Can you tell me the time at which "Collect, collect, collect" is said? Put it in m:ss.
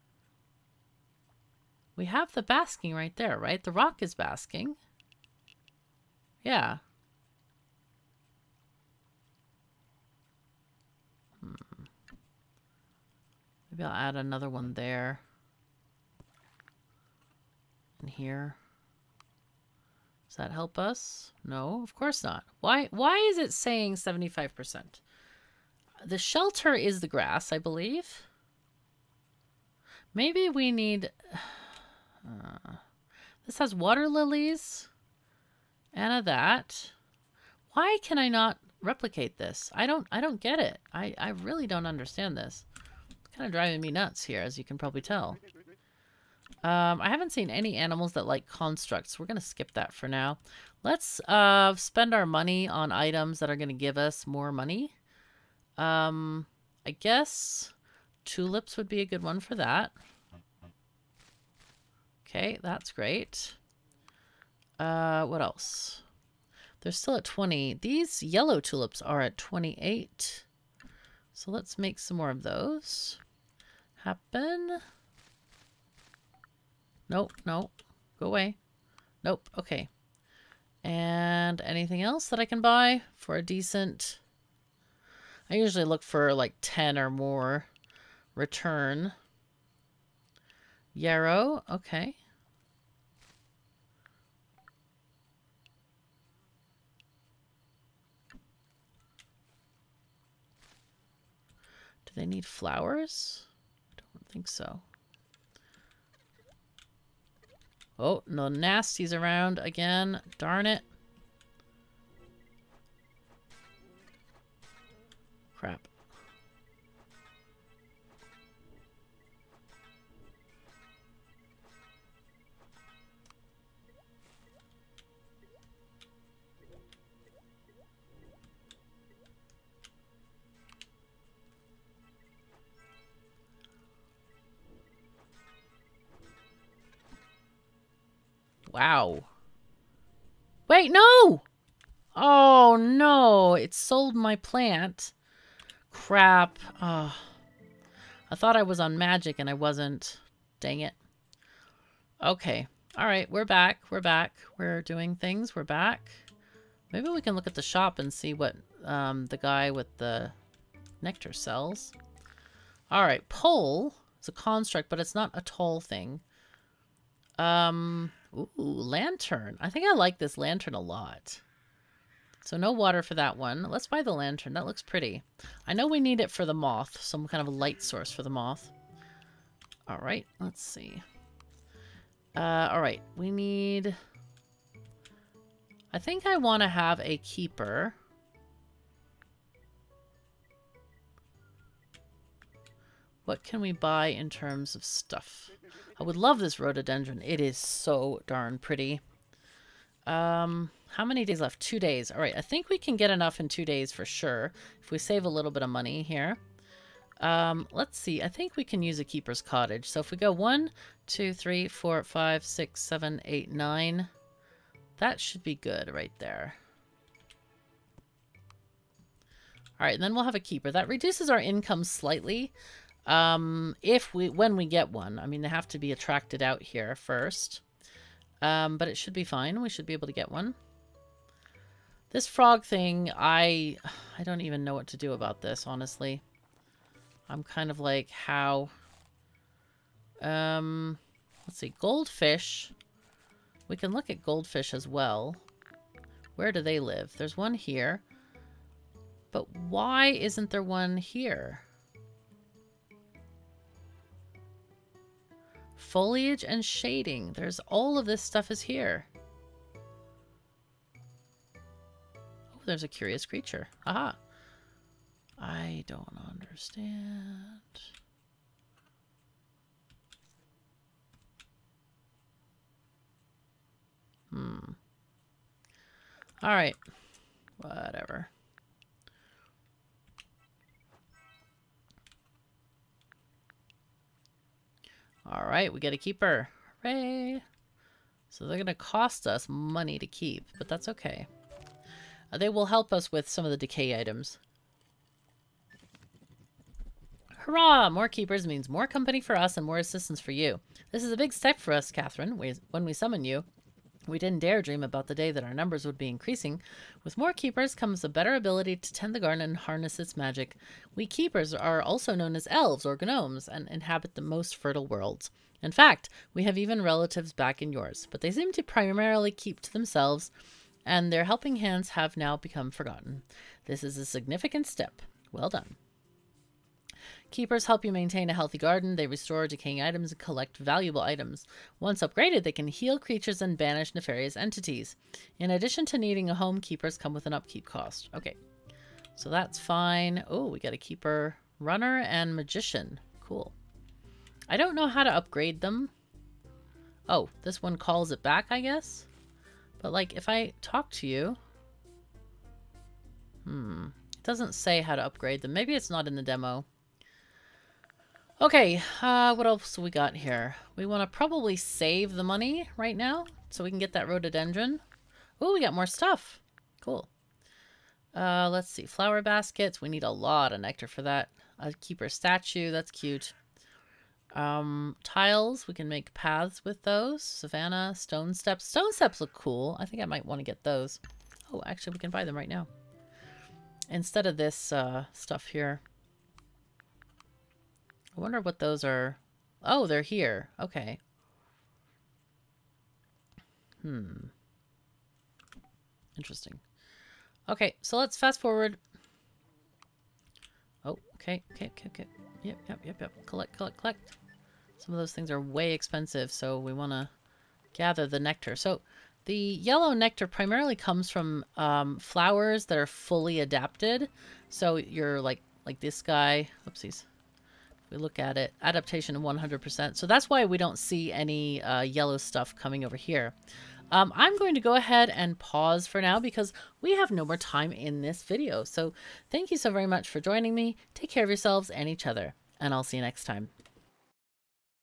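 6:43.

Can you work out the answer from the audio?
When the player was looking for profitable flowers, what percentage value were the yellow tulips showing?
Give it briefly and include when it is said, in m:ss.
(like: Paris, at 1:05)
28, at 1:09.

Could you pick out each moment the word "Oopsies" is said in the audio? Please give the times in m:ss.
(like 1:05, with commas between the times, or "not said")
6:56.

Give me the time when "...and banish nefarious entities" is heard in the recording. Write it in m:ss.
5:33.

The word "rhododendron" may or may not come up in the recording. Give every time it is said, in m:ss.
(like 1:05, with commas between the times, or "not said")
3:16, 6:04.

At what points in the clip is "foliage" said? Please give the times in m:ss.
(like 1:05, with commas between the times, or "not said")
4:15.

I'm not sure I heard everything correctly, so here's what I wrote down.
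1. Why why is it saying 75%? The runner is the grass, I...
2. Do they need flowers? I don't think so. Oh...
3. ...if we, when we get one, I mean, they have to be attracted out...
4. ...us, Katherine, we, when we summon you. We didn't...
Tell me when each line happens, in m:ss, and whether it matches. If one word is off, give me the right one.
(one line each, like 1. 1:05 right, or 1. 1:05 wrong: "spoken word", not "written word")
1. 0:22 wrong: "shelter", not "runner"
2. 1:42 right
3. 3:43 right
4. 5:01 right.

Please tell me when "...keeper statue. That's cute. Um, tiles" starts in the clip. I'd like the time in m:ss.
6:11.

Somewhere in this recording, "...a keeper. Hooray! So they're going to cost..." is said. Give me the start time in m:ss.
4:45.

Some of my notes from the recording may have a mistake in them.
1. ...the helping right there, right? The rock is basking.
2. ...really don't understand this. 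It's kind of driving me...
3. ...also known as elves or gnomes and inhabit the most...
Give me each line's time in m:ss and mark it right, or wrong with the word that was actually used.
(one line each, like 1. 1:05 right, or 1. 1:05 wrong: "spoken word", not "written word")
1. 0:02 wrong: "basking", not "helping"
2. 0:41 right
3. 5:11 right.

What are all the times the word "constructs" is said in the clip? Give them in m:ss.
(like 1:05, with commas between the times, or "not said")
0:48, 2:44.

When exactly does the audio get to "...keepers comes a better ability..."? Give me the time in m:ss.
5:07.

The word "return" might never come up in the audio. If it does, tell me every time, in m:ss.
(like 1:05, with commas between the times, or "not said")
1:28.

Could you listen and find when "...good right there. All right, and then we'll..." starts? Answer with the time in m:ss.
3:35.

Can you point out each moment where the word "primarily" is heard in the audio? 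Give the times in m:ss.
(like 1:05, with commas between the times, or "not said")
5:18, 6:50.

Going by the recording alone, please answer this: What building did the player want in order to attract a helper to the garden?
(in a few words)
Keeper's cottage.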